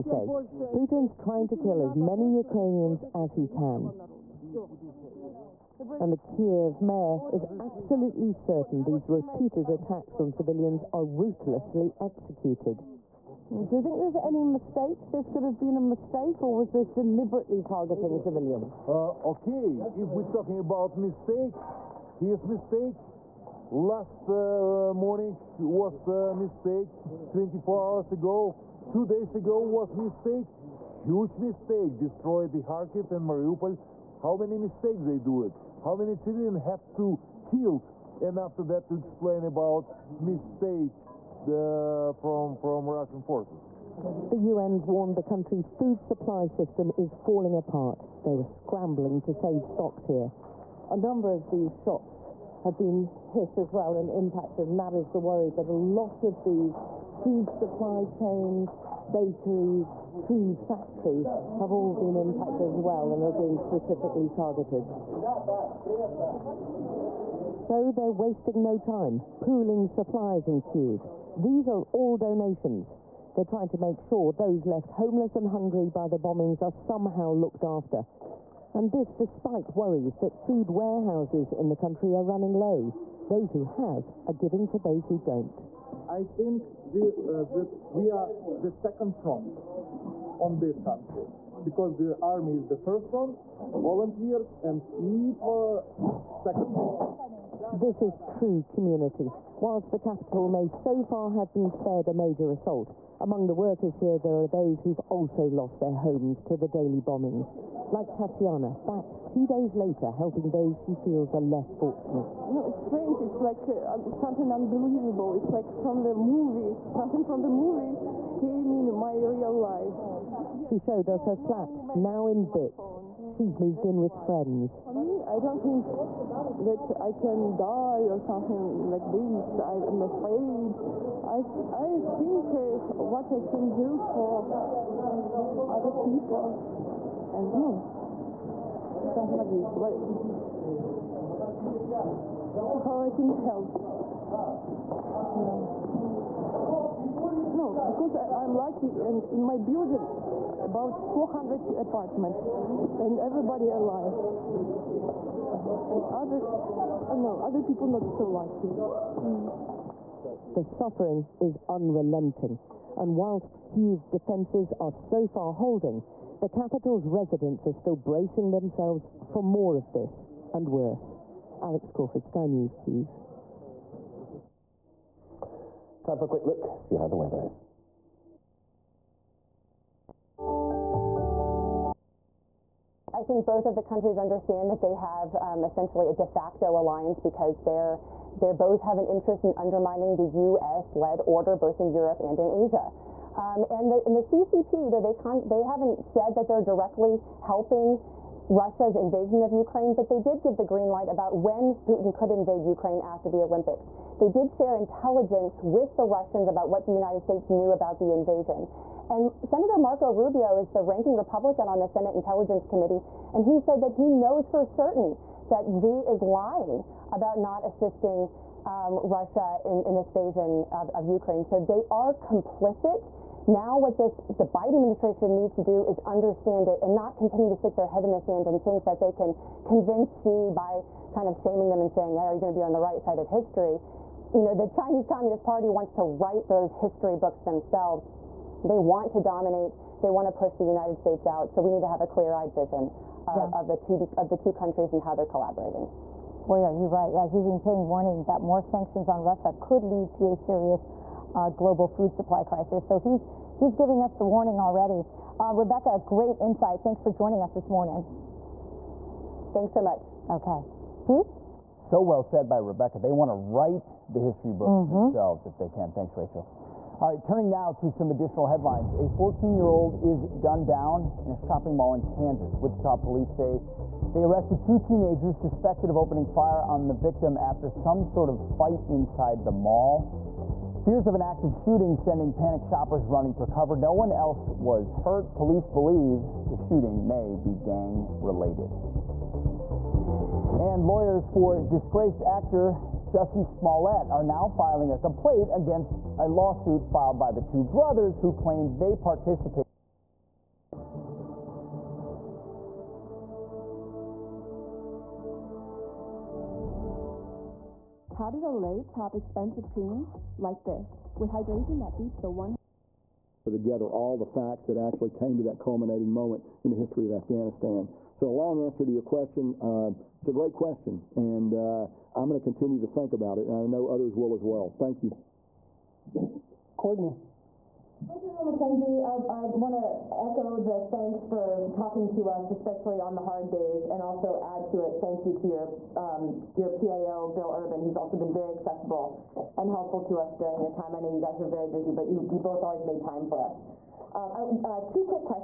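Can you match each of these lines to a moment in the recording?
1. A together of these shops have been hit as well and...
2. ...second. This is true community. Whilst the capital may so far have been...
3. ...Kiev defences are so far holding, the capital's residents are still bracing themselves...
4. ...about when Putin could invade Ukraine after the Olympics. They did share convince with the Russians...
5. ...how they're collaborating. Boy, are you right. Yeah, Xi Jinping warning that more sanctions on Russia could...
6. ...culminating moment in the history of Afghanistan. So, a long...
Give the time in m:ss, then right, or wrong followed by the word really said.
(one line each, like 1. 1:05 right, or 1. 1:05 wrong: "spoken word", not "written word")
1. 0:50 wrong: "number", not "together"
2. 1:35 right
3. 2:43 right
4. 3:21 wrong: "intelligence", not "convince"
5. 4:05 right
6. 5:15 right.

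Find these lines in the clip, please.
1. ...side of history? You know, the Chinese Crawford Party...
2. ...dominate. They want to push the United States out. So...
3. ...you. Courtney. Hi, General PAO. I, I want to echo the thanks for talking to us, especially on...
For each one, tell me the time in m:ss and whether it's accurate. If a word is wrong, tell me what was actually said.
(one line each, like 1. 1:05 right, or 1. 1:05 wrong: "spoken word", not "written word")
1. 3:53 wrong: "Communist", not "Crawford"
2. 3:59 right
3. 5:25 wrong: "McKenzie", not "PAO".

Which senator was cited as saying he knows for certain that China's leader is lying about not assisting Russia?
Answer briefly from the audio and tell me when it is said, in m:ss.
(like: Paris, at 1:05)
Marco Rubio, at 3:29.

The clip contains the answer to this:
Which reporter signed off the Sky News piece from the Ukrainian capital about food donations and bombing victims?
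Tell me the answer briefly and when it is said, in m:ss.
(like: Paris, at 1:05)
Alex Crawford, at 2:51.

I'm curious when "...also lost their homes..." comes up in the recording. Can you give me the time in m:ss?
1:45.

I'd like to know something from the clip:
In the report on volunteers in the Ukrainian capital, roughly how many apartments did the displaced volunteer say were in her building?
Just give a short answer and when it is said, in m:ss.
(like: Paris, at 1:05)
400, at 2:30.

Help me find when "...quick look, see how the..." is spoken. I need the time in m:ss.
2:56.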